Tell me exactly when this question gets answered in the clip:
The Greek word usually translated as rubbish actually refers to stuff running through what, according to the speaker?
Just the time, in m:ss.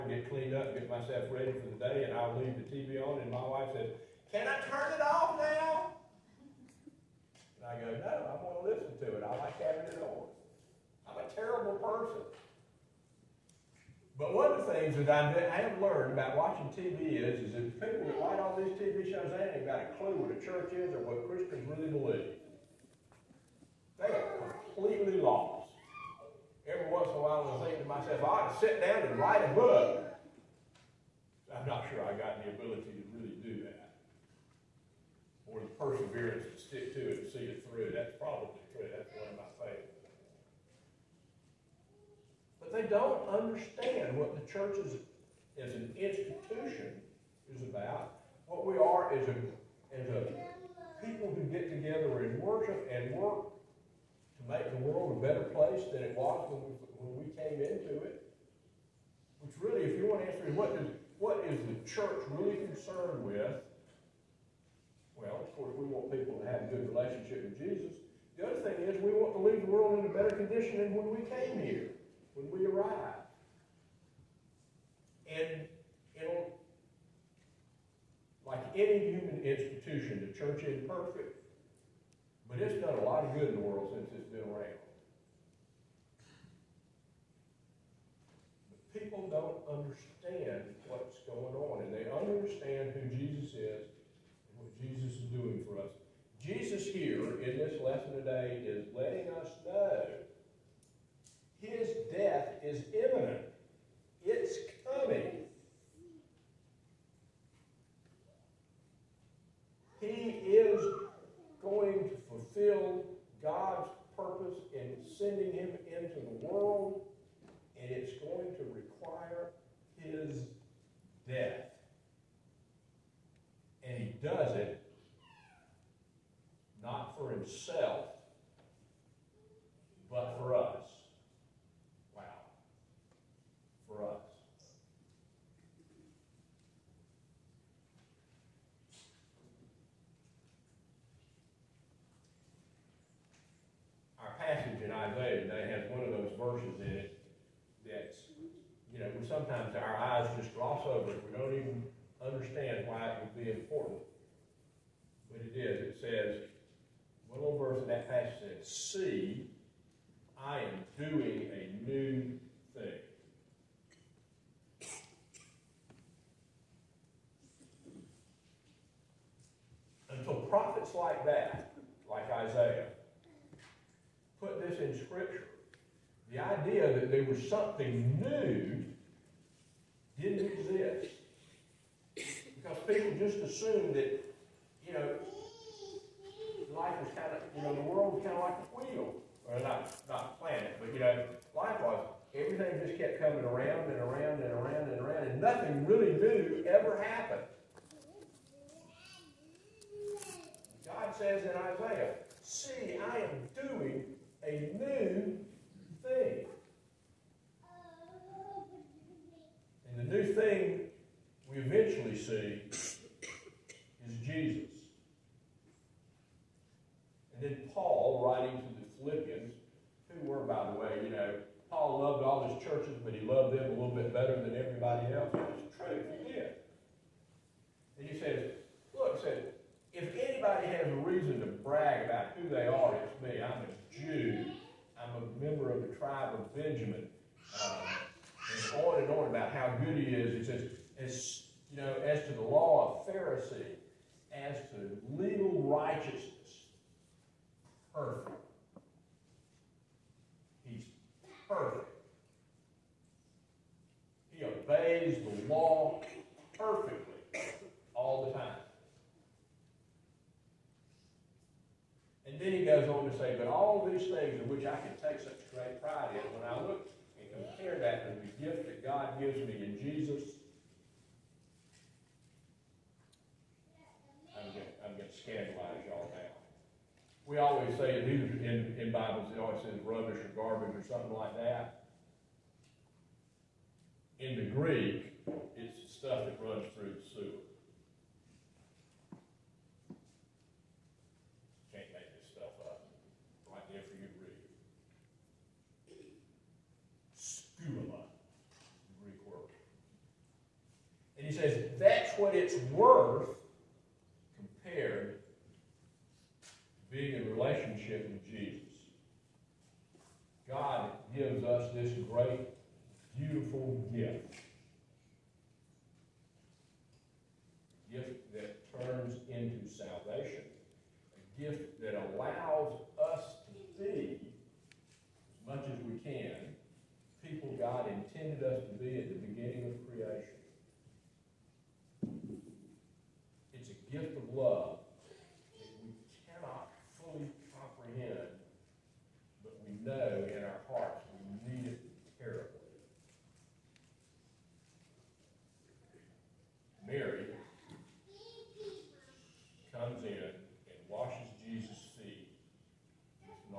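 4:46.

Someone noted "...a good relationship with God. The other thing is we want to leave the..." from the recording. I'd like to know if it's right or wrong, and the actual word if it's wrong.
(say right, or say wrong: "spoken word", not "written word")
wrong: "Jesus", not "God".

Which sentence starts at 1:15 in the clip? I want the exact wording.
And it'll, like any human institution, the church is imperfect.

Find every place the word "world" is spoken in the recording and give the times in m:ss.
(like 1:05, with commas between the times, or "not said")
0:54, 1:09, 1:23, 3:07.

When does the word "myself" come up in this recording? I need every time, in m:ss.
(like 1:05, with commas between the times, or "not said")
0:00, 0:27.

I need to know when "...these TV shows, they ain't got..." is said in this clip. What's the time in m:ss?
0:18.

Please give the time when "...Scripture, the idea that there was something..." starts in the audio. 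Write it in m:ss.
2:55.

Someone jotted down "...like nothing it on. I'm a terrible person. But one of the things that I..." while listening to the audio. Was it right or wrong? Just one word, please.
wrong.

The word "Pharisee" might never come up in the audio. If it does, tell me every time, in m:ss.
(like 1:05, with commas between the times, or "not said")
4:03.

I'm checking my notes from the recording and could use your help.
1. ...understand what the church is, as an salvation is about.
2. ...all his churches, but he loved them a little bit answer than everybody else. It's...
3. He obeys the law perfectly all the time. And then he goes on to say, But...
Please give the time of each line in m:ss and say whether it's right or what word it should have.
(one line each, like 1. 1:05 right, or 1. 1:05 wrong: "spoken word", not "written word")
1. 0:43 wrong: "institution", not "salvation"
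2. 3:42 wrong: "better", not "answer"
3. 4:14 right.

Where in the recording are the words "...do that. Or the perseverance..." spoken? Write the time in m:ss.
0:33.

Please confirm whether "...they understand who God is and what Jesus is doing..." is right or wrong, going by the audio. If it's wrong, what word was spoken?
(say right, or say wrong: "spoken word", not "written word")
wrong: "Jesus", not "God".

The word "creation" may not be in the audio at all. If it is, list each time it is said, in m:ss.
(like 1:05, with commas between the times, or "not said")
5:29.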